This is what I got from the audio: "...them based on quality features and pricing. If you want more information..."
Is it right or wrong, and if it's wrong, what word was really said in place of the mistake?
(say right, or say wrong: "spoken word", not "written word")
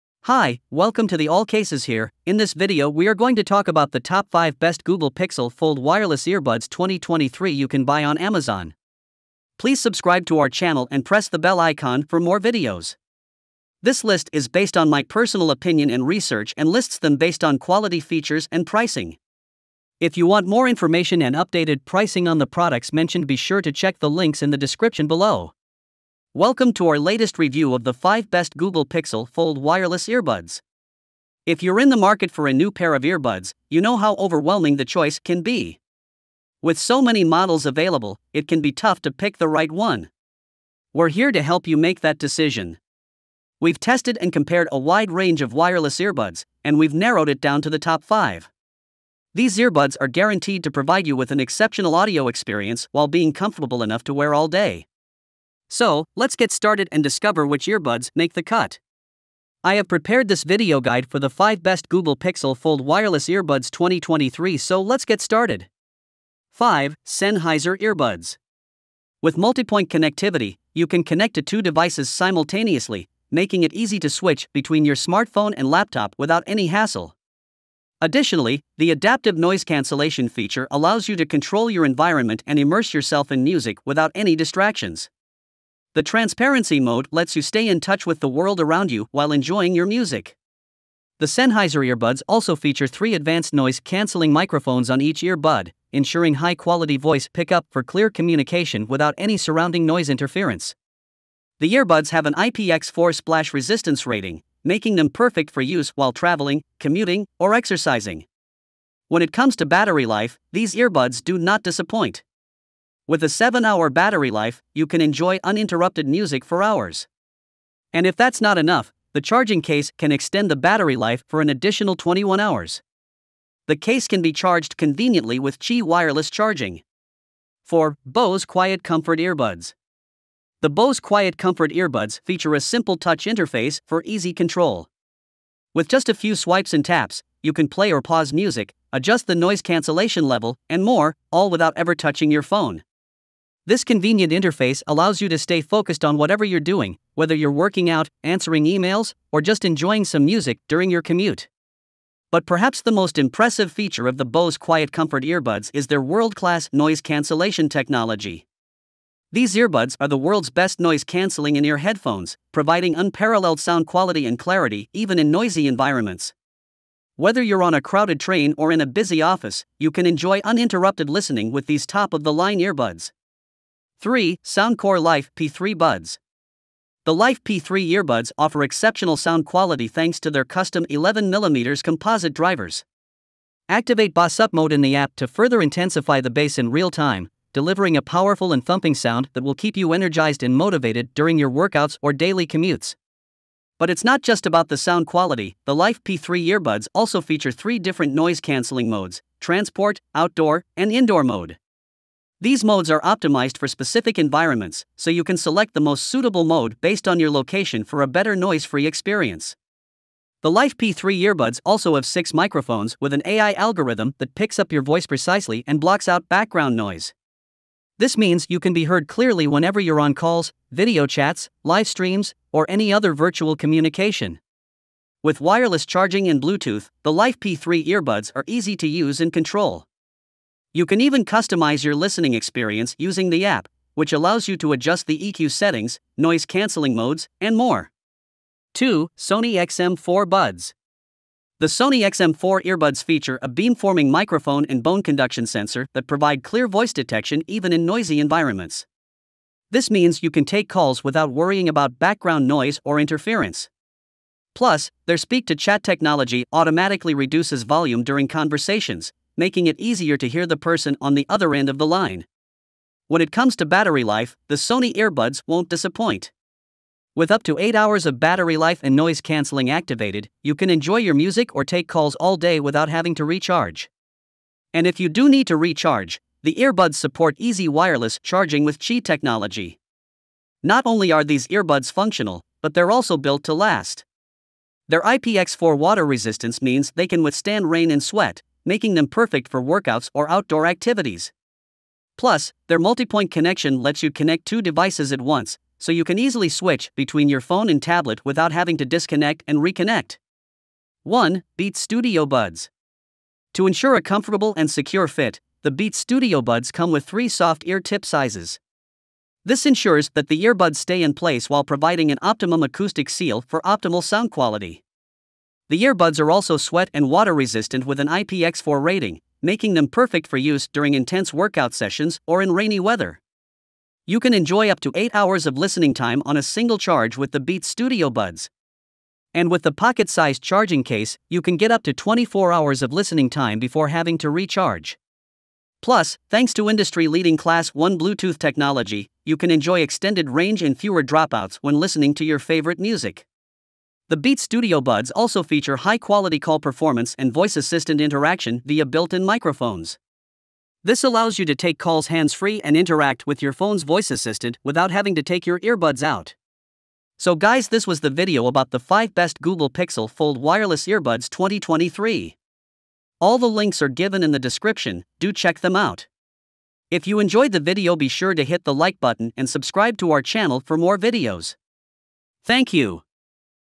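right.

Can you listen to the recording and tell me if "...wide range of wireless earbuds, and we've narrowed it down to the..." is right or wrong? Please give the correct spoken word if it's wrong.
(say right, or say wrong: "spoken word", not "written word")
right.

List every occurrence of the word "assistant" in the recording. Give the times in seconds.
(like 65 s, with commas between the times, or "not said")
347 s, 354 s.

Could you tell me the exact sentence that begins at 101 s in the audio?
The earbuds have an IPX4 splash resistance rating, making them perfect for use while traveling, commuting, or exercising.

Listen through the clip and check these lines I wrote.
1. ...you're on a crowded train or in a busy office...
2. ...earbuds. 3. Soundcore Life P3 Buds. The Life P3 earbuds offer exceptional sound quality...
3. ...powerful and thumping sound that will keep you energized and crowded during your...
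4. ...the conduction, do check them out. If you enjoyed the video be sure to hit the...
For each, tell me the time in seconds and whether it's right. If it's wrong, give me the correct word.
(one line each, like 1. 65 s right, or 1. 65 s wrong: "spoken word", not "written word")
1. 167 s right
2. 172 s right
3. 188 s wrong: "motivated", not "crowded"
4. 364 s wrong: "description", not "conduction".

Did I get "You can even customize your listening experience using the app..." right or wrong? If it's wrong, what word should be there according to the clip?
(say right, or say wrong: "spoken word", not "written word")
right.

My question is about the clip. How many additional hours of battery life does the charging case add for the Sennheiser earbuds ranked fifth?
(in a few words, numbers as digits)
21.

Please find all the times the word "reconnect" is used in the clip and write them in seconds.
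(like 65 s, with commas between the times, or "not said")
299 s.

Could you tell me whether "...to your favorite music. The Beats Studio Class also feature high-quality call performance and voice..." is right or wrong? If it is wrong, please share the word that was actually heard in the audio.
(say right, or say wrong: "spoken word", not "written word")
wrong: "Buds", not "Class".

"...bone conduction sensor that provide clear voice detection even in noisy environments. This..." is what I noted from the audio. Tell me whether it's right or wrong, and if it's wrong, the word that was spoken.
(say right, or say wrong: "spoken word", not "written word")
right.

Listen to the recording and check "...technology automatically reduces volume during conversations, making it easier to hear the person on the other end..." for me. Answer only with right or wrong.
right.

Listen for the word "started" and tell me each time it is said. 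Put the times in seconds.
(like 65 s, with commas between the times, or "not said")
56 s, 65 s.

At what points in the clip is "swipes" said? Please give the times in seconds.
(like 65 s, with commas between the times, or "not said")
136 s.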